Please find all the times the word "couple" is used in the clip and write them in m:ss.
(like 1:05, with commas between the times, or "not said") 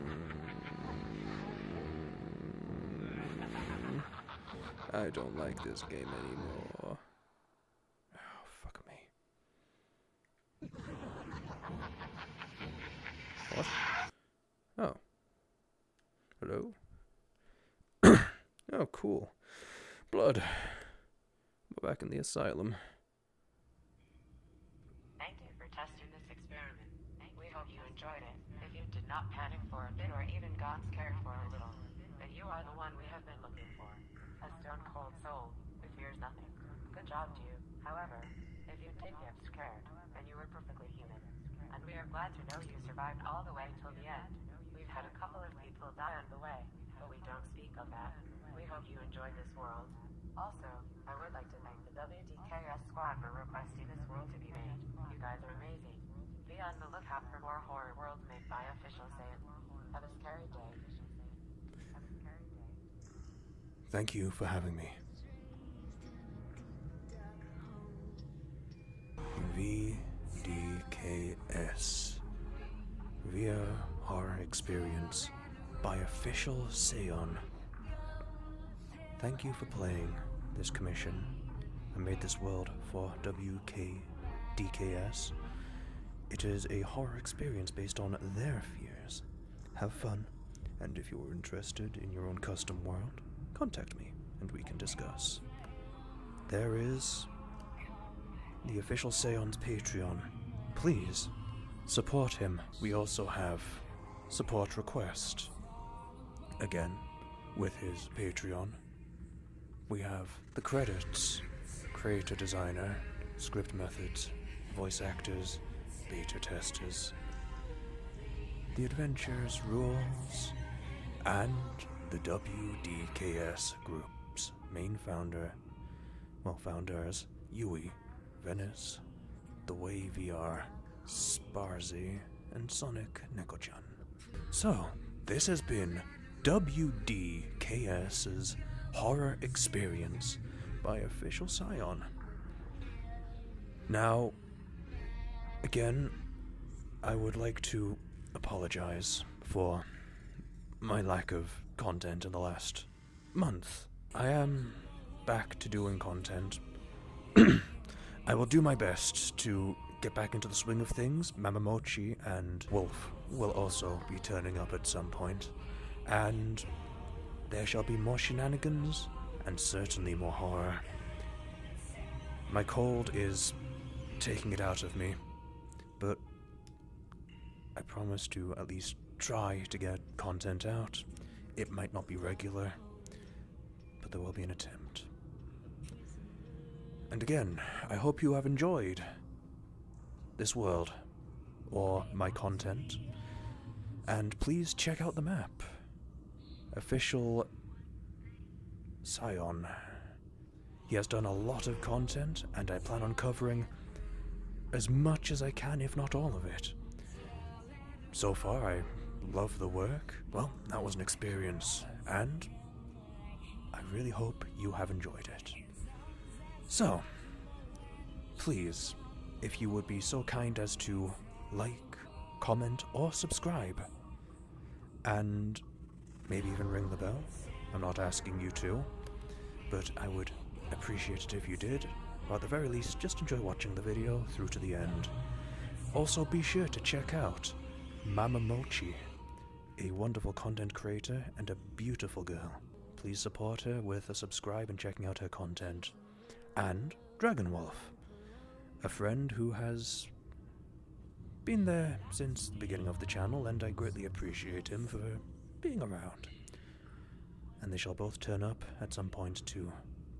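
0:45.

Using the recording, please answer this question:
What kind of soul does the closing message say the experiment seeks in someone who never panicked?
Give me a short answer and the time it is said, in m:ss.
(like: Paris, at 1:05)
Stone cold, at 0:34.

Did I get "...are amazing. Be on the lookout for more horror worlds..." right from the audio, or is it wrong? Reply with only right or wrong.
right.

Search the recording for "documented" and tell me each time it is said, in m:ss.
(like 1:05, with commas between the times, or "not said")
not said.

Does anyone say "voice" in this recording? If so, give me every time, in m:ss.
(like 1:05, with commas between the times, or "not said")
1:54.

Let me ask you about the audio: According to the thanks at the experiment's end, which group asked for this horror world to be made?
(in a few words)
WDKS squad.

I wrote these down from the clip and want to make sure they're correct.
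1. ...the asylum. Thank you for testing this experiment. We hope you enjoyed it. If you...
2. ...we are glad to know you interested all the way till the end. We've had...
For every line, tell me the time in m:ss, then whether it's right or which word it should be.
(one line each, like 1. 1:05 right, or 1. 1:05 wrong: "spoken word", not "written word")
1. 0:22 right
2. 0:41 wrong: "survived", not "interested".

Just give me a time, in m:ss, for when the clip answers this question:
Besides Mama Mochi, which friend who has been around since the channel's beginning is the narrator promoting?
4:07.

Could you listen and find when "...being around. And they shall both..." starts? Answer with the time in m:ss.
4:15.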